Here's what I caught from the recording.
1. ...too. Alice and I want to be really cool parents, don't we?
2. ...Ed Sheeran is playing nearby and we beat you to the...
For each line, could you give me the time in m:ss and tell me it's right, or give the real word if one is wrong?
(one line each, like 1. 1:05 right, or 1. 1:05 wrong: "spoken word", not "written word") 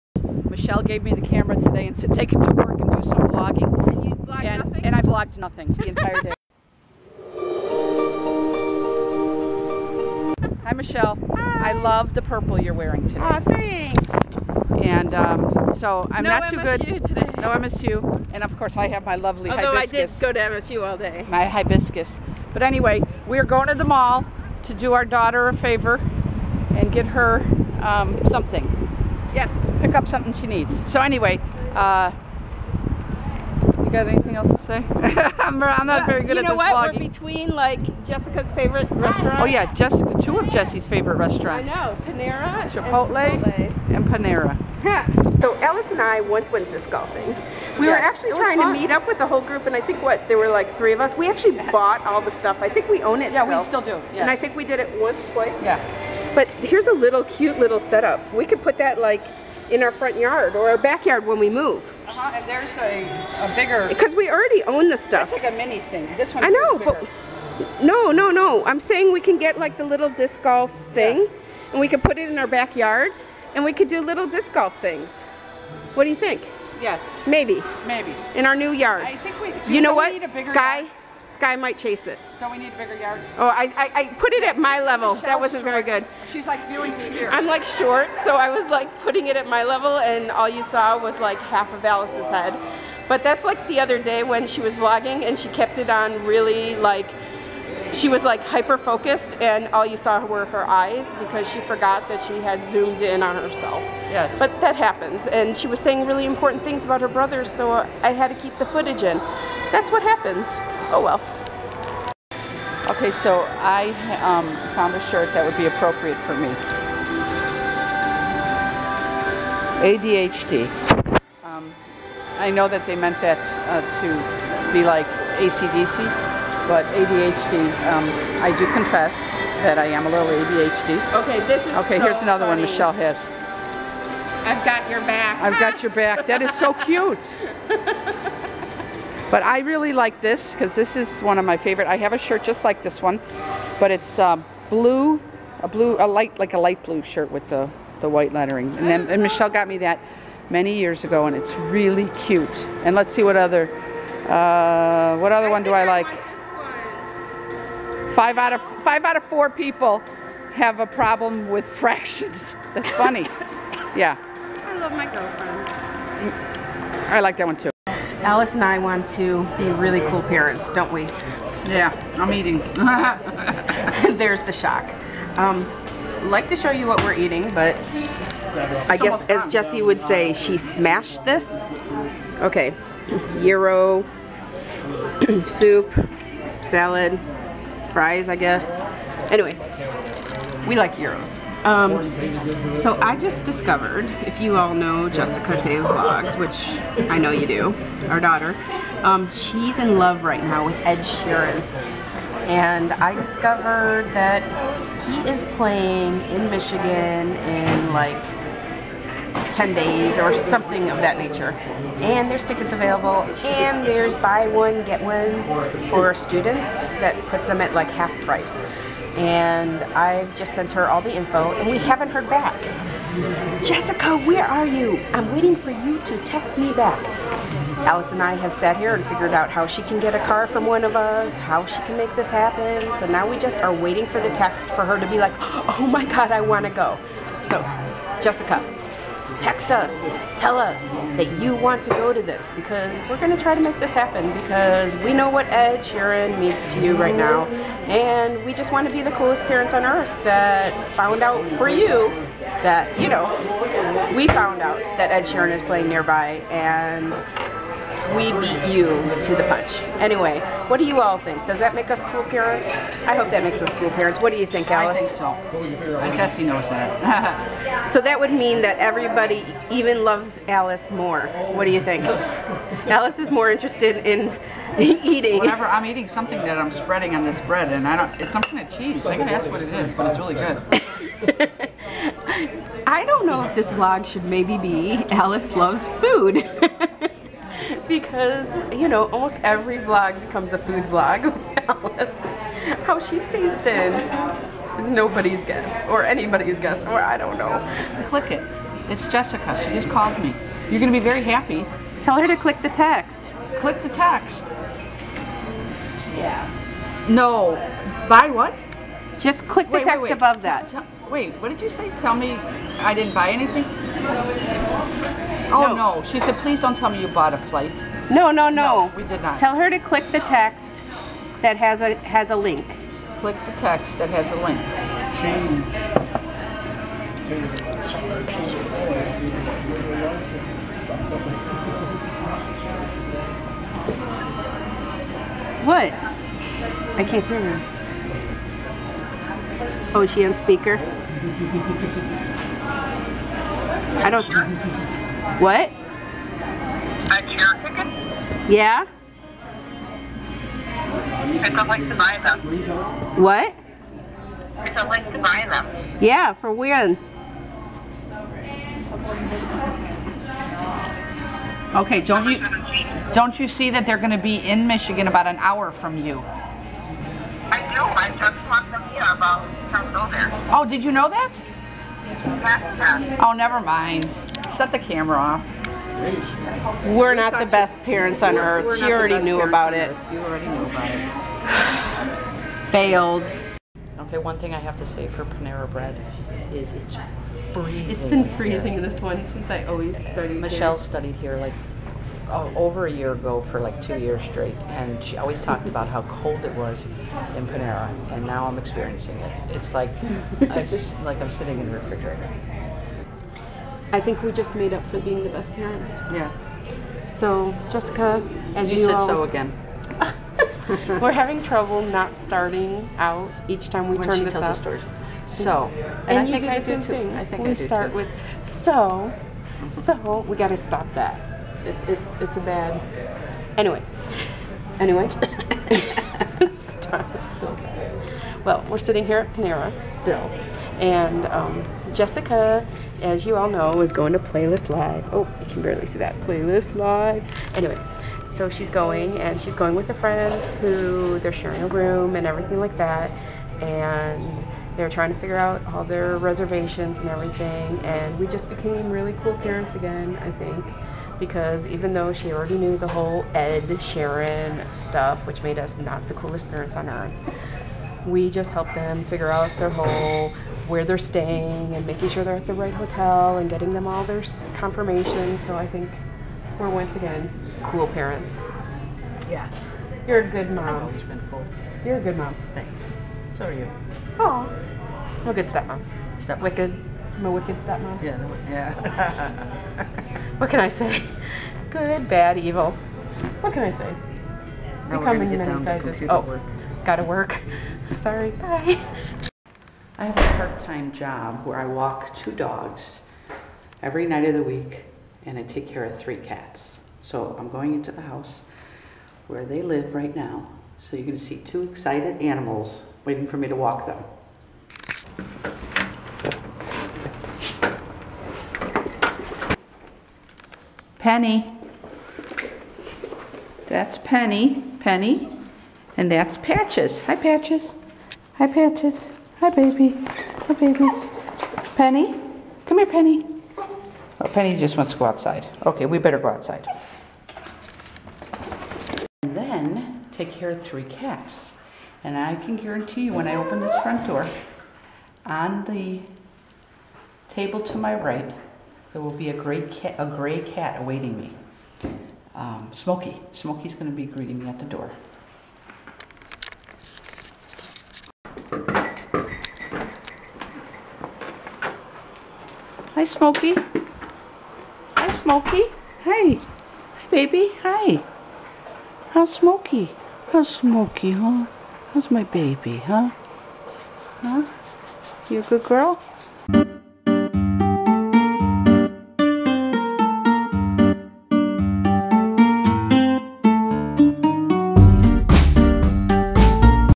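1. 2:47 right
2. 4:15 right.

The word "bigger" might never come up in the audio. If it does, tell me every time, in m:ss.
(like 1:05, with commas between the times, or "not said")
1:03, 1:22.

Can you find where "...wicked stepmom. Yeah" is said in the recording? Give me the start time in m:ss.
7:57.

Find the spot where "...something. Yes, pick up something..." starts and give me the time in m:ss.
0:28.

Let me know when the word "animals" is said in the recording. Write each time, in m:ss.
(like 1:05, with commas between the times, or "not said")
8:22.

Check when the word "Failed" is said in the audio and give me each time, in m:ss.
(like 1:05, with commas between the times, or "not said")
6:22.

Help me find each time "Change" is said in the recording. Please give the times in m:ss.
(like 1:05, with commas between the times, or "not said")
5:25.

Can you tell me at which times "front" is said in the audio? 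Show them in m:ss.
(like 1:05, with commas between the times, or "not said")
0:59, 8:53.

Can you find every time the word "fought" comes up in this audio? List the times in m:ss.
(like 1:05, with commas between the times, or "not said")
not said.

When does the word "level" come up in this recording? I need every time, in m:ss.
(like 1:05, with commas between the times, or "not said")
1:24, 1:29.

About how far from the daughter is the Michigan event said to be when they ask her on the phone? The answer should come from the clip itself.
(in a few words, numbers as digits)
An hour.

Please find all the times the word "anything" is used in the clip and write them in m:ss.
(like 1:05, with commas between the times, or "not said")
0:34, 5:13.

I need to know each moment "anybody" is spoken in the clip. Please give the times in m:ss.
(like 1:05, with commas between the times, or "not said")
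4:56.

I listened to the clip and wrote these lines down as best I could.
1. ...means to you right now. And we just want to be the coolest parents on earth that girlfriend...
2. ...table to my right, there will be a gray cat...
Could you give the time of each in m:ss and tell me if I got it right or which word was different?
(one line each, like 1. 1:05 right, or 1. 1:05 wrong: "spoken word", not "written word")
1. 4:06 wrong: "found", not "girlfriend"
2. 8:57 right.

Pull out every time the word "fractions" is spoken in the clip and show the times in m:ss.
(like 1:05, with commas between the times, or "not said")
2:41.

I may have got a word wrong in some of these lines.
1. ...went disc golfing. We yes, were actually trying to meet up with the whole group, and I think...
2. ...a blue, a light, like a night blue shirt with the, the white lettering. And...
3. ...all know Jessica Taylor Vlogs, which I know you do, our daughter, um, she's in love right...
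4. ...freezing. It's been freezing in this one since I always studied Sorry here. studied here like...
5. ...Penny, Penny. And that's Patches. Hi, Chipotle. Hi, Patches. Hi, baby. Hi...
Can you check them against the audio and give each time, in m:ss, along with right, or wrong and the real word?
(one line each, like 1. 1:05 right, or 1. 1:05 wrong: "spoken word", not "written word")
1. 0:46 right
2. 2:25 wrong: "light", not "night"
3. 3:14 right
4. 6:27 wrong: "Michelle", not "Sorry"
5. 8:33 wrong: "Patches", not "Chipotle".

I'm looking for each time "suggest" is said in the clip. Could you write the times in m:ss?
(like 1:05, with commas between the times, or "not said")
not said.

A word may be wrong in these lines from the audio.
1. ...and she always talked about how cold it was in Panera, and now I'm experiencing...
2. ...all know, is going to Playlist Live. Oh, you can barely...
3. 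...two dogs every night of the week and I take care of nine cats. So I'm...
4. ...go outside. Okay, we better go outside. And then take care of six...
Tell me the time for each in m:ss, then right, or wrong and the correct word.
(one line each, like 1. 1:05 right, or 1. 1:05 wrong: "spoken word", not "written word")
1. 6:34 right
2. 7:13 right
3. 8:12 wrong: "three", not "nine"
4. 8:44 wrong: "three", not "six".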